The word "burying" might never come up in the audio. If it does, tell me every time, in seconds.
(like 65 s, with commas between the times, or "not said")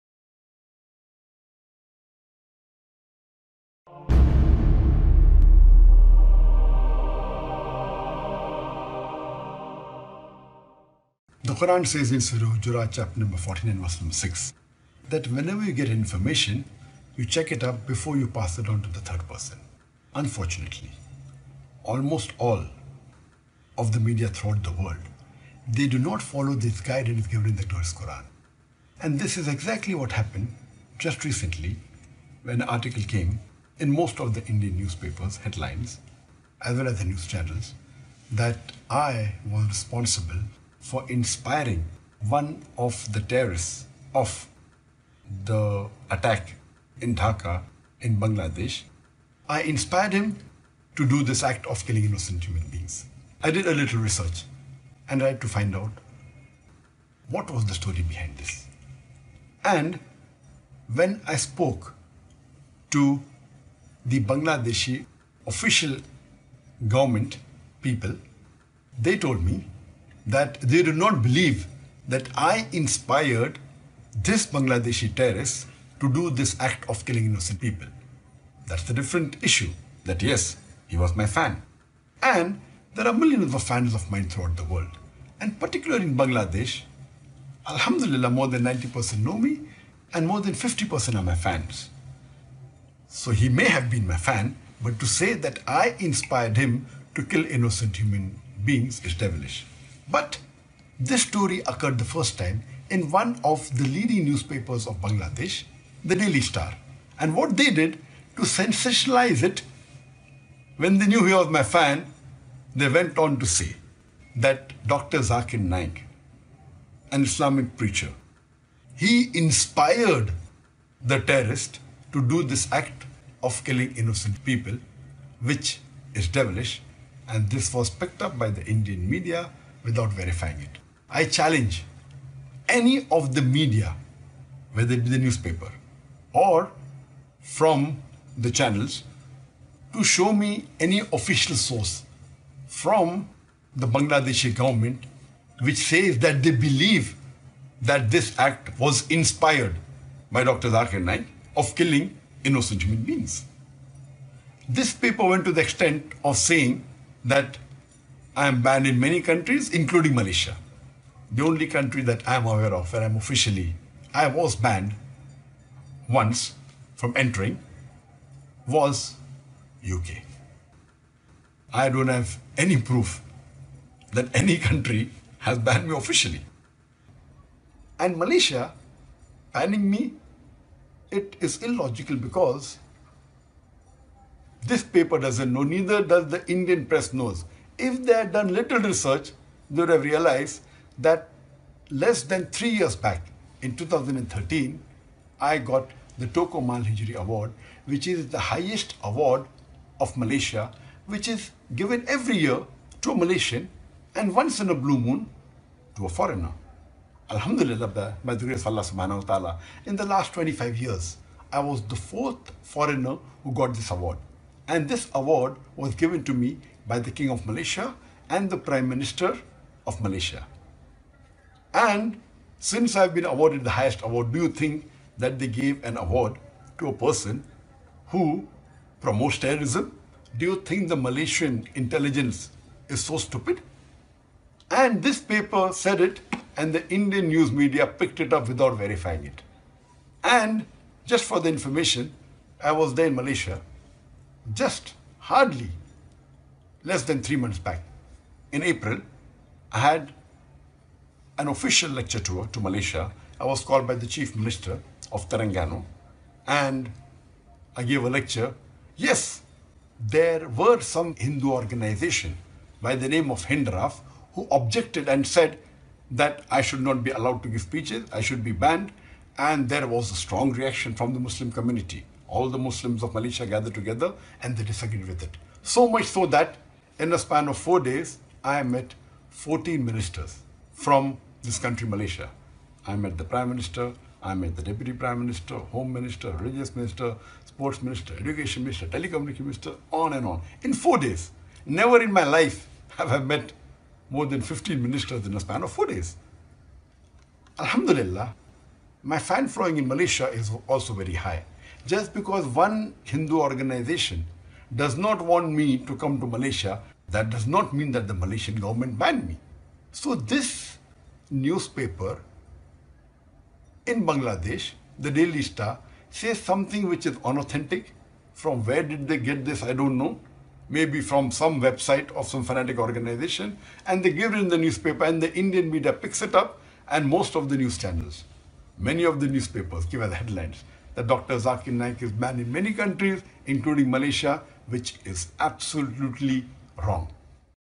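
not said.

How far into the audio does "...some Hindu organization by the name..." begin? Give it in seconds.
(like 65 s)
260 s.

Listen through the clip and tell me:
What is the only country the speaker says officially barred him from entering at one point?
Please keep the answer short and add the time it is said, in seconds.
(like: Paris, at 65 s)
UK, at 169 s.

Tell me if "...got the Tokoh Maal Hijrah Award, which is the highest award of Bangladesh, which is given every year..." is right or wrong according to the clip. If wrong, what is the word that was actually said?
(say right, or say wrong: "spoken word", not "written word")
wrong: "Malaysia", not "Bangladesh".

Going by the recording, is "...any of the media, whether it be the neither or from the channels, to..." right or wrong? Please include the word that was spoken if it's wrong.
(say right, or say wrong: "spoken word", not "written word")
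wrong: "newspaper", not "neither".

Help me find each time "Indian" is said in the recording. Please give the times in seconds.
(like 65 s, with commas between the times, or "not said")
34 s, 128 s, 186 s, 236 s, 325 s.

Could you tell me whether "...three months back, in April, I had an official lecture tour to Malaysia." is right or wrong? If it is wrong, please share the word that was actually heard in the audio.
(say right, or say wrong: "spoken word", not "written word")
right.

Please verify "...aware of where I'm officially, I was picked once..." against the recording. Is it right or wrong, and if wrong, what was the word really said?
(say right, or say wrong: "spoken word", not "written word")
wrong: "banned", not "picked".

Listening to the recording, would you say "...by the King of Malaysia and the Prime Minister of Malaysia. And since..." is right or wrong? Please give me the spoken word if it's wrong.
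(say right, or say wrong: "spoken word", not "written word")
right.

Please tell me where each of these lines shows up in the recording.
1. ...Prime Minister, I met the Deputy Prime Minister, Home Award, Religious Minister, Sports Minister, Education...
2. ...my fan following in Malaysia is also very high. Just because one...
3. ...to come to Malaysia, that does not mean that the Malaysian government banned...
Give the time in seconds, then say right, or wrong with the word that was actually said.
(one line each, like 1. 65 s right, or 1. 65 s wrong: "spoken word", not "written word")
1. 283 s wrong: "Minister", not "Award"
2. 299 s right
3. 305 s right.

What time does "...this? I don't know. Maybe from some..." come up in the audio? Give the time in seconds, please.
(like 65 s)
319 s.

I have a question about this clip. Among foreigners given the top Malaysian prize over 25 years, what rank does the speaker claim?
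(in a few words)
fourth.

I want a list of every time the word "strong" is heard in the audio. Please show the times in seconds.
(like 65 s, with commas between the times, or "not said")
270 s.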